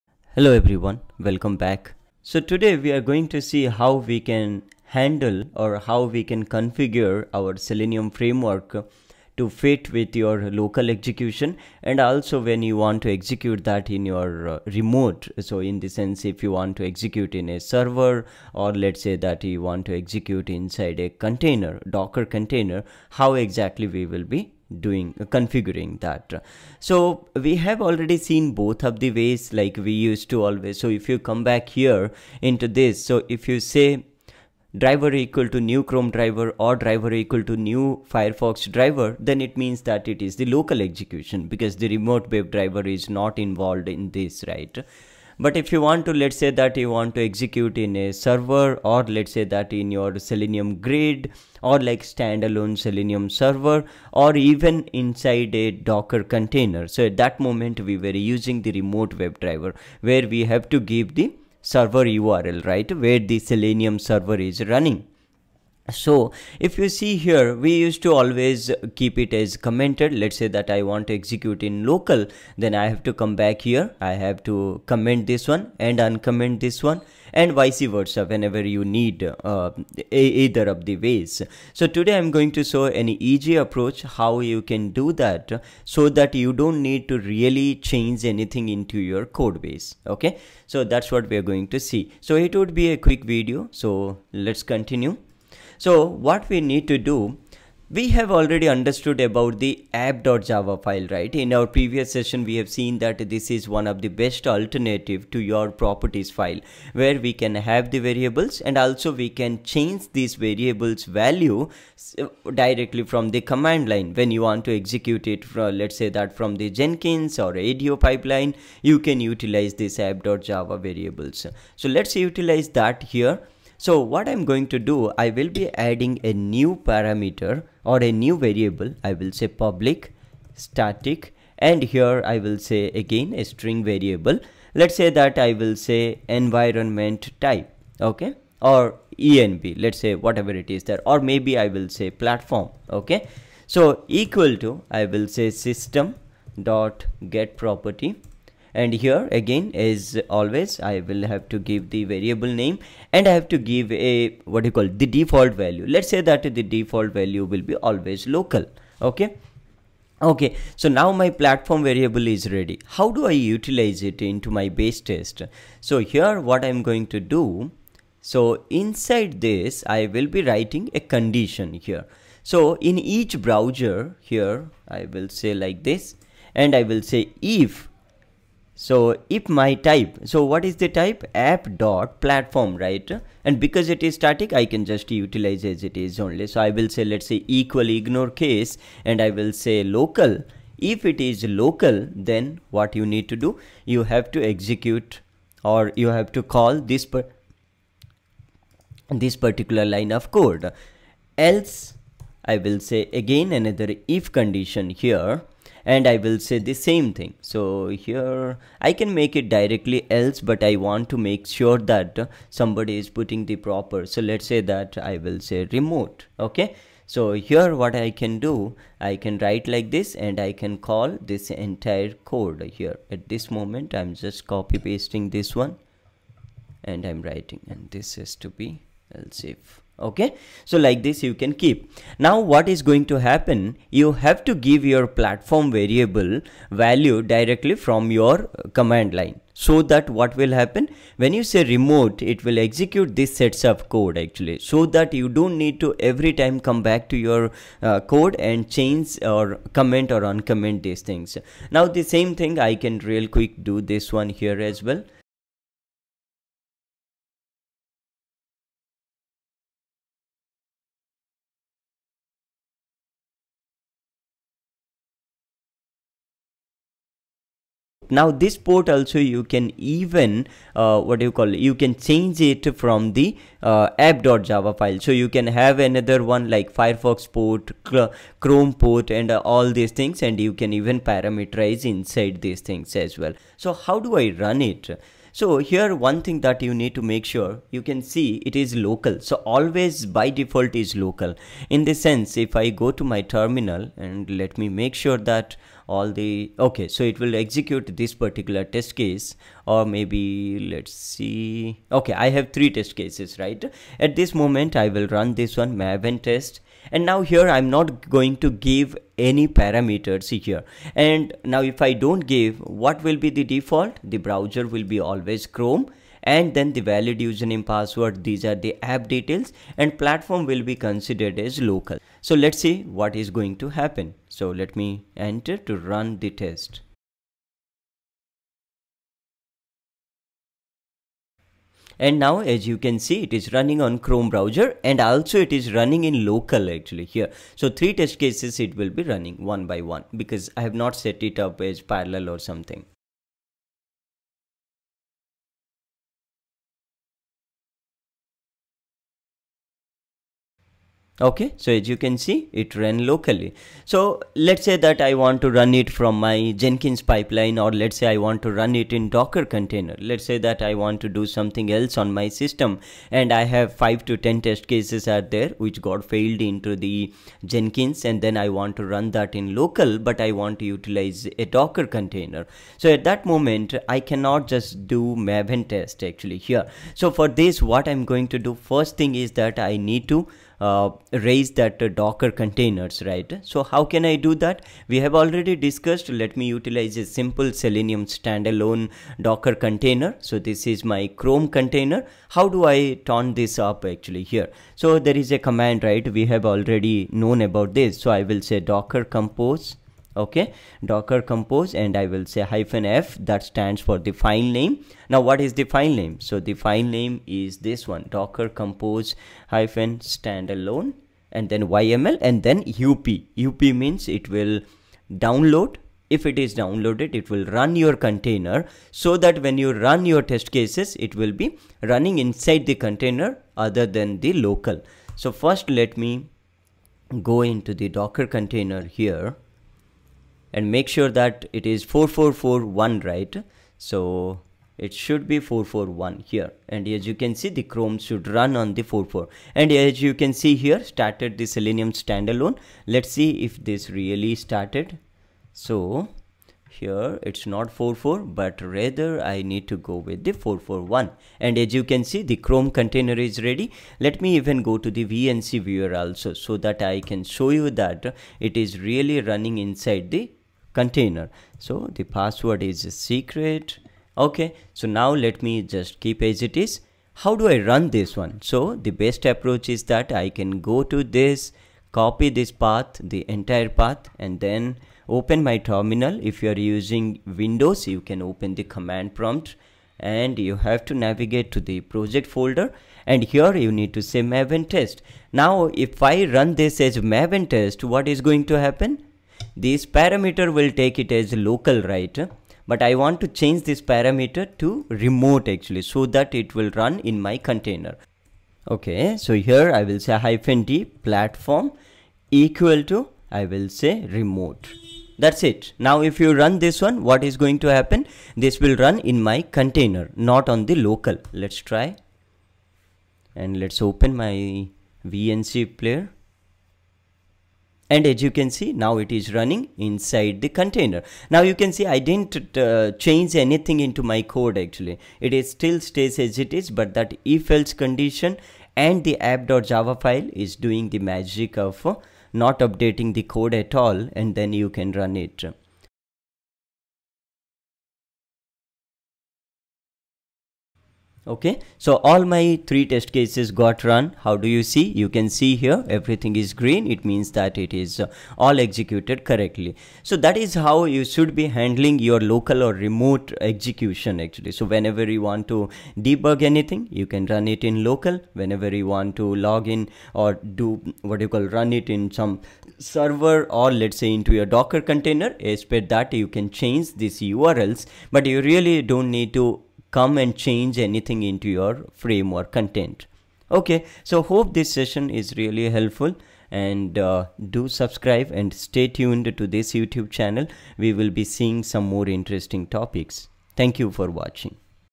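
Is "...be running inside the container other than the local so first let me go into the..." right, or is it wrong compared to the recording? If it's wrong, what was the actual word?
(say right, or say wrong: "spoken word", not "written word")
right.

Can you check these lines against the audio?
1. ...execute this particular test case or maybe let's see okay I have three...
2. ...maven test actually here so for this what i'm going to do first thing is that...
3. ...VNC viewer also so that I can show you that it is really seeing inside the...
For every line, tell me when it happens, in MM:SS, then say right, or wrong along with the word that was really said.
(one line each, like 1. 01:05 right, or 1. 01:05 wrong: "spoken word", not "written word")
1. 04:57 right
2. 06:15 right
3. 07:35 wrong: "running", not "seeing".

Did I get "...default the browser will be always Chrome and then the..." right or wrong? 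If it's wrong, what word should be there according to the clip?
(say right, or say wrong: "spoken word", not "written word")
right.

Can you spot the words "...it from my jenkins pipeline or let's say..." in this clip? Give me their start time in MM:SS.
05:55.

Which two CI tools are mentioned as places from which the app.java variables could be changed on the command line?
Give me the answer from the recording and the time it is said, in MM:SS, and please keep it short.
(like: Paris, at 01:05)
Jenkins or ADO, at 01:56.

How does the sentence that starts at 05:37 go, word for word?
So three test cases it will be running one by one because I have not set it up as parallel or something.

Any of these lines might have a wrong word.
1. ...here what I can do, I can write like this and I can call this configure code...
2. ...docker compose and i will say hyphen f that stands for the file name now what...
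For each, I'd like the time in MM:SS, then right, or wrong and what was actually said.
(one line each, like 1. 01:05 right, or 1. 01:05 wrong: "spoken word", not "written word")
1. 03:37 wrong: "entire", not "configure"
2. 06:40 right.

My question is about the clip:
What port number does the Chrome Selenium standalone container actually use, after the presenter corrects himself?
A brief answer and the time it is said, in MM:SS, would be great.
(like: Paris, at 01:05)
4441, at 07:11.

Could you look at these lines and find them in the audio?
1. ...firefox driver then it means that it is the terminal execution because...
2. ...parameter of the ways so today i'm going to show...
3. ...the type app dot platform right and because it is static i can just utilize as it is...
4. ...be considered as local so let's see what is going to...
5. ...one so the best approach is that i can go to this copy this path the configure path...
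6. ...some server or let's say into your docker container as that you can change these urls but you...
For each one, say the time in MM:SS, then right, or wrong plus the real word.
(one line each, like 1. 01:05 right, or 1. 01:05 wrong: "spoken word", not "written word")
1. 00:38 wrong: "local", not "terminal"
2. 01:20 wrong: "either", not "parameter"
3. 03:00 right
4. 05:20 right
5. 07:48 wrong: "entire", not "configure"
6. 09:22 right.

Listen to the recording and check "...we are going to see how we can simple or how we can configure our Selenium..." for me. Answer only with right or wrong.
wrong.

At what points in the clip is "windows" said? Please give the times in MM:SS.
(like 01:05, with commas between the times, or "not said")
07:57.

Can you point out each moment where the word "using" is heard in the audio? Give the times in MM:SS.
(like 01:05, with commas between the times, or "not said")
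00:58, 07:56.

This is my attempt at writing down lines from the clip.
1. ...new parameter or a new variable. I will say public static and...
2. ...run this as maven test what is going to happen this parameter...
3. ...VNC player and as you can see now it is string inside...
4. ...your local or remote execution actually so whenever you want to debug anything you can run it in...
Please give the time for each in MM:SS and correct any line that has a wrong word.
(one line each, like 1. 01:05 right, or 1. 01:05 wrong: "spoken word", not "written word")
1. 02:06 right
2. 08:06 right
3. 08:35 wrong: "running", not "string"
4. 09:11 right.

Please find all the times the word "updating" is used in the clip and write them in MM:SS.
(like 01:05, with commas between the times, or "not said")
08:52.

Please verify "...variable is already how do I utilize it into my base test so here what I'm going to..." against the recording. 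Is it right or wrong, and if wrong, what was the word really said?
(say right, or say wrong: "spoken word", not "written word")
wrong: "ready", not "already".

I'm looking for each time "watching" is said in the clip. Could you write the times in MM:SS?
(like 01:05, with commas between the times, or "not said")
09:44.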